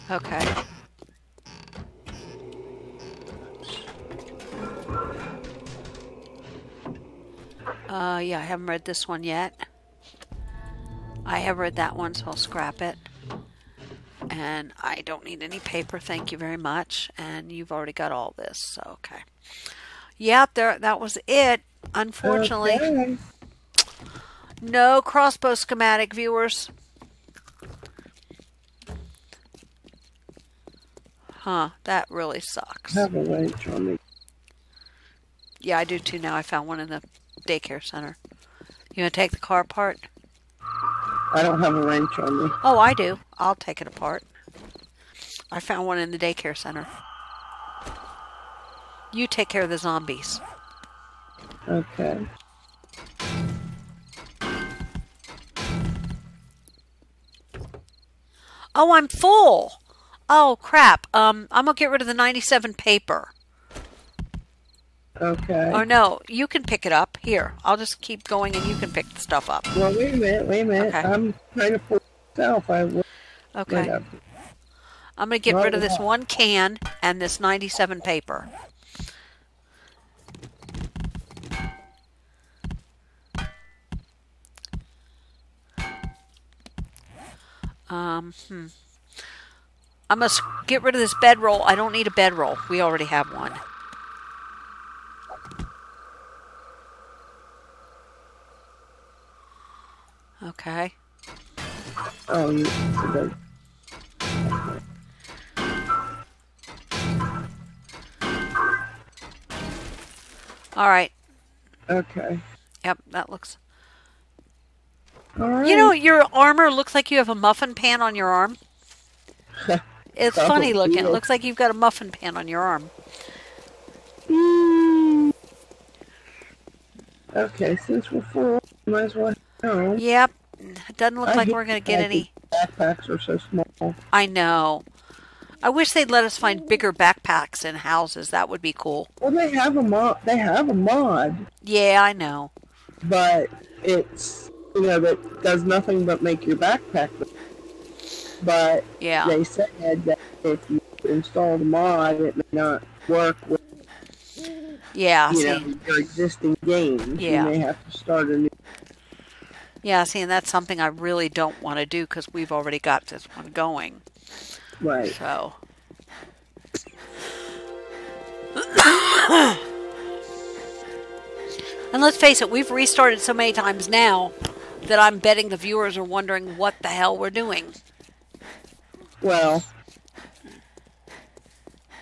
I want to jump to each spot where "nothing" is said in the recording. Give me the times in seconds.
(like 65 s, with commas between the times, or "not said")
145 s.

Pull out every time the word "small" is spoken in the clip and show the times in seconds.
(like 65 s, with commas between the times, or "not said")
133 s.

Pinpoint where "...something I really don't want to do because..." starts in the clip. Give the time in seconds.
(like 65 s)
160 s.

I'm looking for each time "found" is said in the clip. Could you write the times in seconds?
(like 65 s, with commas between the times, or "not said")
36 s, 45 s.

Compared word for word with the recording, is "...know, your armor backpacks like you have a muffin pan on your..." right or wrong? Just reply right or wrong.
wrong.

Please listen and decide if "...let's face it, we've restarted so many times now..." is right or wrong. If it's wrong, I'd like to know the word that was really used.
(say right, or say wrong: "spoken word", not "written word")
right.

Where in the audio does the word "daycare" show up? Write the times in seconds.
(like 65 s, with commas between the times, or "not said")
37 s, 46 s.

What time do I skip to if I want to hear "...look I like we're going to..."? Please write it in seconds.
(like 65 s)
131 s.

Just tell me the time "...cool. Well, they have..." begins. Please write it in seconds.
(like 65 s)
138 s.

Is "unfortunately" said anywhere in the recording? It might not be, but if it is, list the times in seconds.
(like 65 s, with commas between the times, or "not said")
21 s.